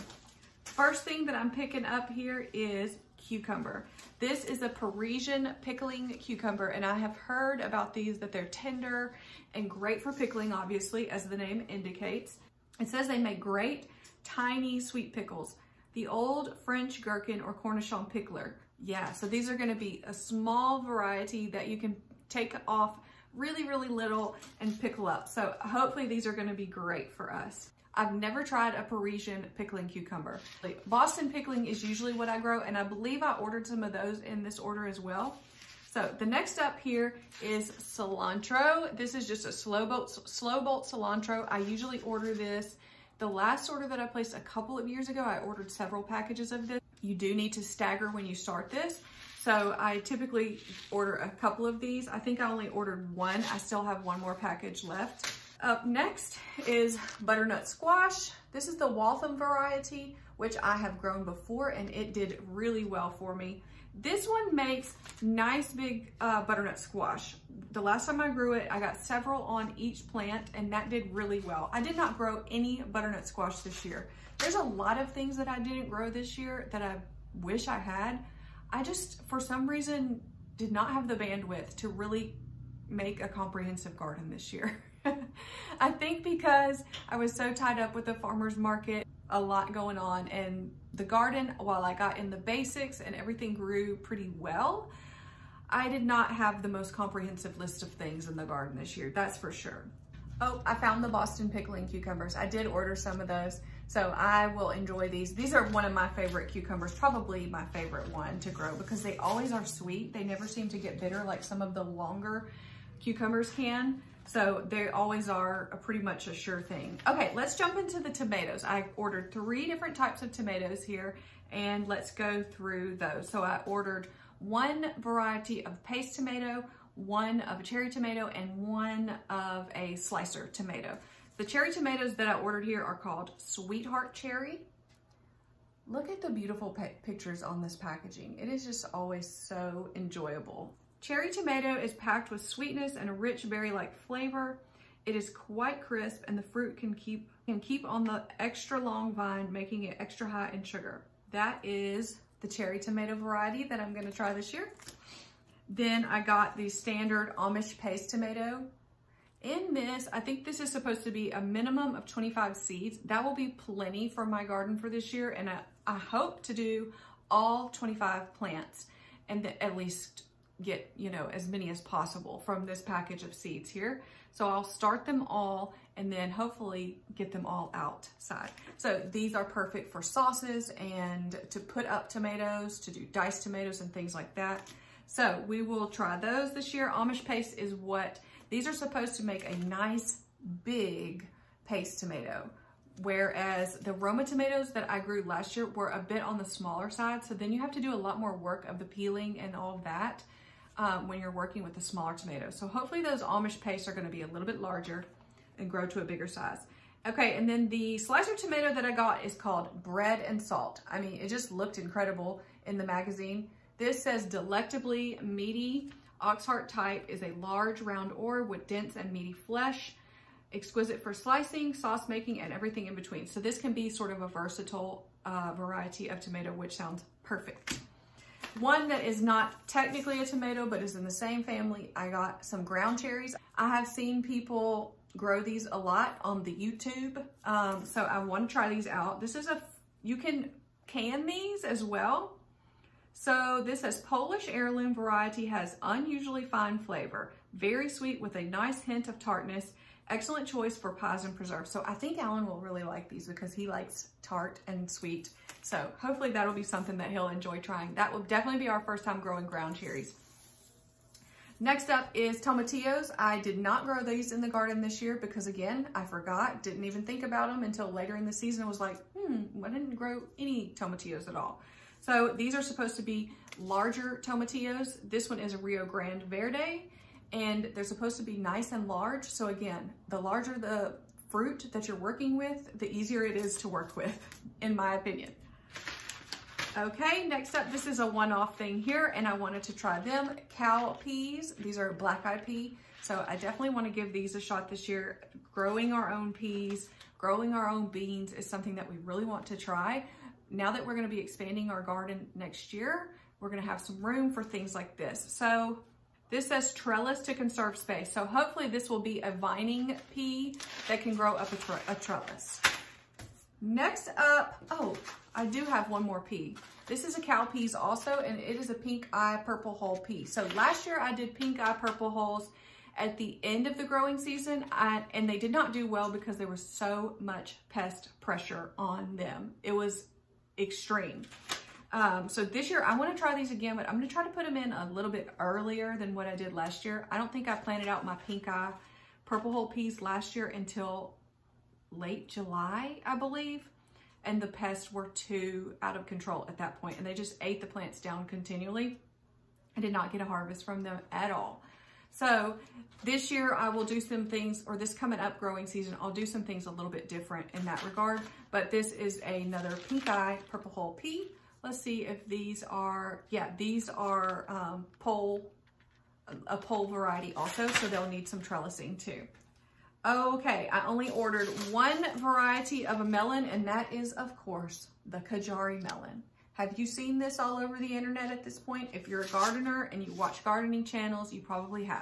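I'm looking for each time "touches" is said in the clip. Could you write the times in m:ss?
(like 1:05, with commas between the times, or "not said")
not said.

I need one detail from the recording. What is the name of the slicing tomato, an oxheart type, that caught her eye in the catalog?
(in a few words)
Bread and Salt.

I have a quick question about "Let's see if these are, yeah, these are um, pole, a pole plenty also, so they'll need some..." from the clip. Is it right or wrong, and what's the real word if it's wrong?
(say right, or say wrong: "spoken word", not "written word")
wrong: "variety", not "plenty".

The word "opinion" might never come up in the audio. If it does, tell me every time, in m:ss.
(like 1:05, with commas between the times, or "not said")
4:44.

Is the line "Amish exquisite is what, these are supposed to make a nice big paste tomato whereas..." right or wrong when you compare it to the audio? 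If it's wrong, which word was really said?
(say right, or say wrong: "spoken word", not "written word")
wrong: "paste", not "exquisite".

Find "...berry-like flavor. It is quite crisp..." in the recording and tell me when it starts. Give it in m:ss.
2:23.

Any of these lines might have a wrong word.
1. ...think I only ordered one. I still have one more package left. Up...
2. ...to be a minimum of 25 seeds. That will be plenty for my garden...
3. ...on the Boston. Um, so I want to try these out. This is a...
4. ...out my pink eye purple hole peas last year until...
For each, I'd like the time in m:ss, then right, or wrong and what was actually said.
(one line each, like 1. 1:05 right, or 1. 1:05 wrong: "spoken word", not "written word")
1. 0:52 right
2. 2:41 right
3. 3:56 wrong: "YouTube", not "Boston"
4. 5:37 right.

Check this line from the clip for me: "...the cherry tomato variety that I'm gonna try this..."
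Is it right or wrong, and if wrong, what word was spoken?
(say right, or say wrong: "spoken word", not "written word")
right.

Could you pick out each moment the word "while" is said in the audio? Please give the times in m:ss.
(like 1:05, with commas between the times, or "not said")
1:31.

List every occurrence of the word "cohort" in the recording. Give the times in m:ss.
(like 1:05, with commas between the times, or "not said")
not said.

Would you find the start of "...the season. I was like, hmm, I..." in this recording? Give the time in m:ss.
4:28.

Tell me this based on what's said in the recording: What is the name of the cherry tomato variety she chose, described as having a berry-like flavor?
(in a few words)
Sweetheart Cherry.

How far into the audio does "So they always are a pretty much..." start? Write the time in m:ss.
1:54.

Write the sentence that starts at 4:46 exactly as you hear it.
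Okay, next up, this is a one-off thing here, and I wanted to try them.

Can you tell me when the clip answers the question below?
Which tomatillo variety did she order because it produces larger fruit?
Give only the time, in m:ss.
4:35.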